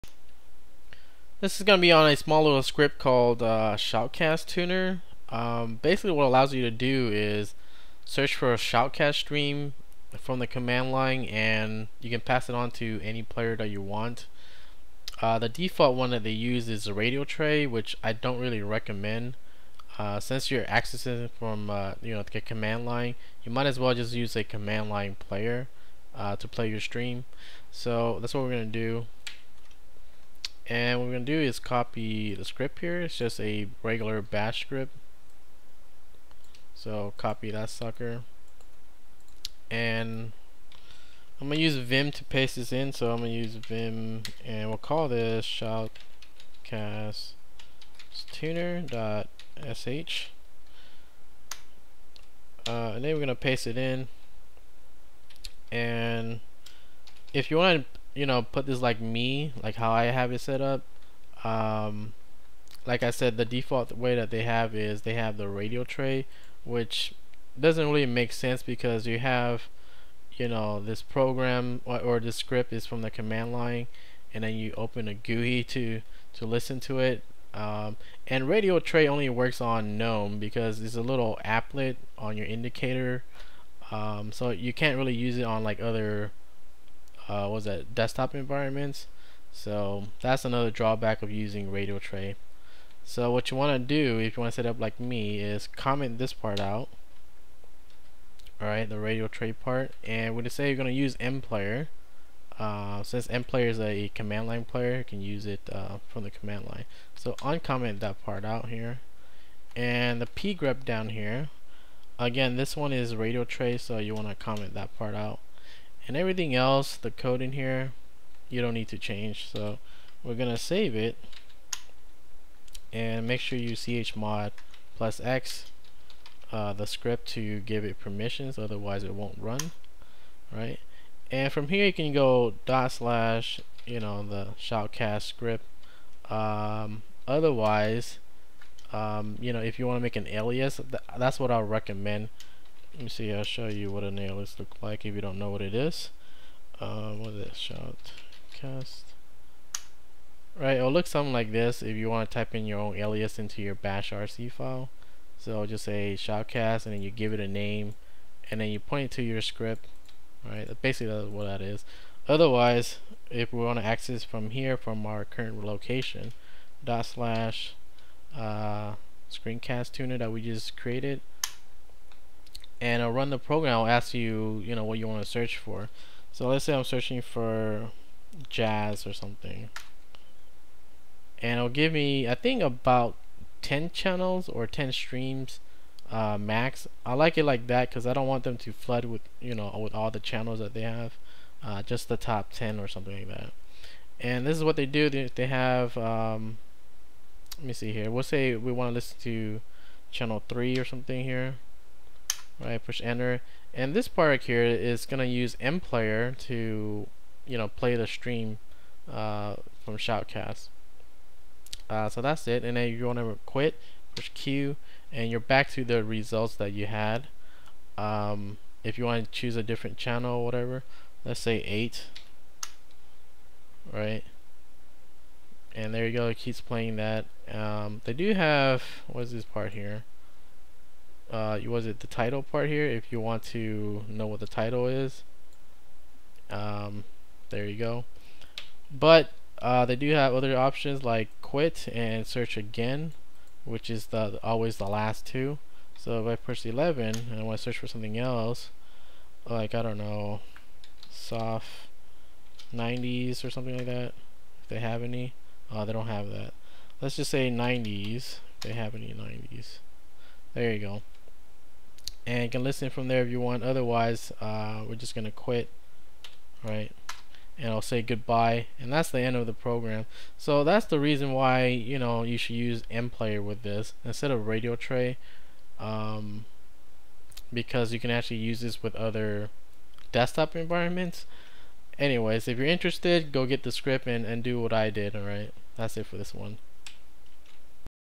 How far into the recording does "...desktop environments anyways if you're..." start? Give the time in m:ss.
4:40.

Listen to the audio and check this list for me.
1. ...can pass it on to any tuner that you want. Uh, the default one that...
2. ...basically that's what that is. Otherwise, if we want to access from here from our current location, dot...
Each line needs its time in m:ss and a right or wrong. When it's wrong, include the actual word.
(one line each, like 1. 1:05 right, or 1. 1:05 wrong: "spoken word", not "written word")
1. 0:12 wrong: "player", not "tuner"
2. 2:40 right.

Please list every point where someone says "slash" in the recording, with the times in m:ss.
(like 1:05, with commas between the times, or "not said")
2:12, 2:47.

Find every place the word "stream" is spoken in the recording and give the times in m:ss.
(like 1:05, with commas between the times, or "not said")
0:09, 0:26, 3:04, 3:28.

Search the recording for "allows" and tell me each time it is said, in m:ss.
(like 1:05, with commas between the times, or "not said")
0:06.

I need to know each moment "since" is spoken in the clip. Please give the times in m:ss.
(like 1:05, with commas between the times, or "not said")
0:20, 1:43.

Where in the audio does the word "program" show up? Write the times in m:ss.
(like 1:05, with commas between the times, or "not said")
1:11, 2:53, 4:29.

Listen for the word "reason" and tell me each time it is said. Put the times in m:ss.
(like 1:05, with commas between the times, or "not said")
4:30.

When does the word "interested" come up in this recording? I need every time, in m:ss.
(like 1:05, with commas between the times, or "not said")
4:42.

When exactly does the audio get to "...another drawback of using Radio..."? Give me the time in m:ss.
1:30.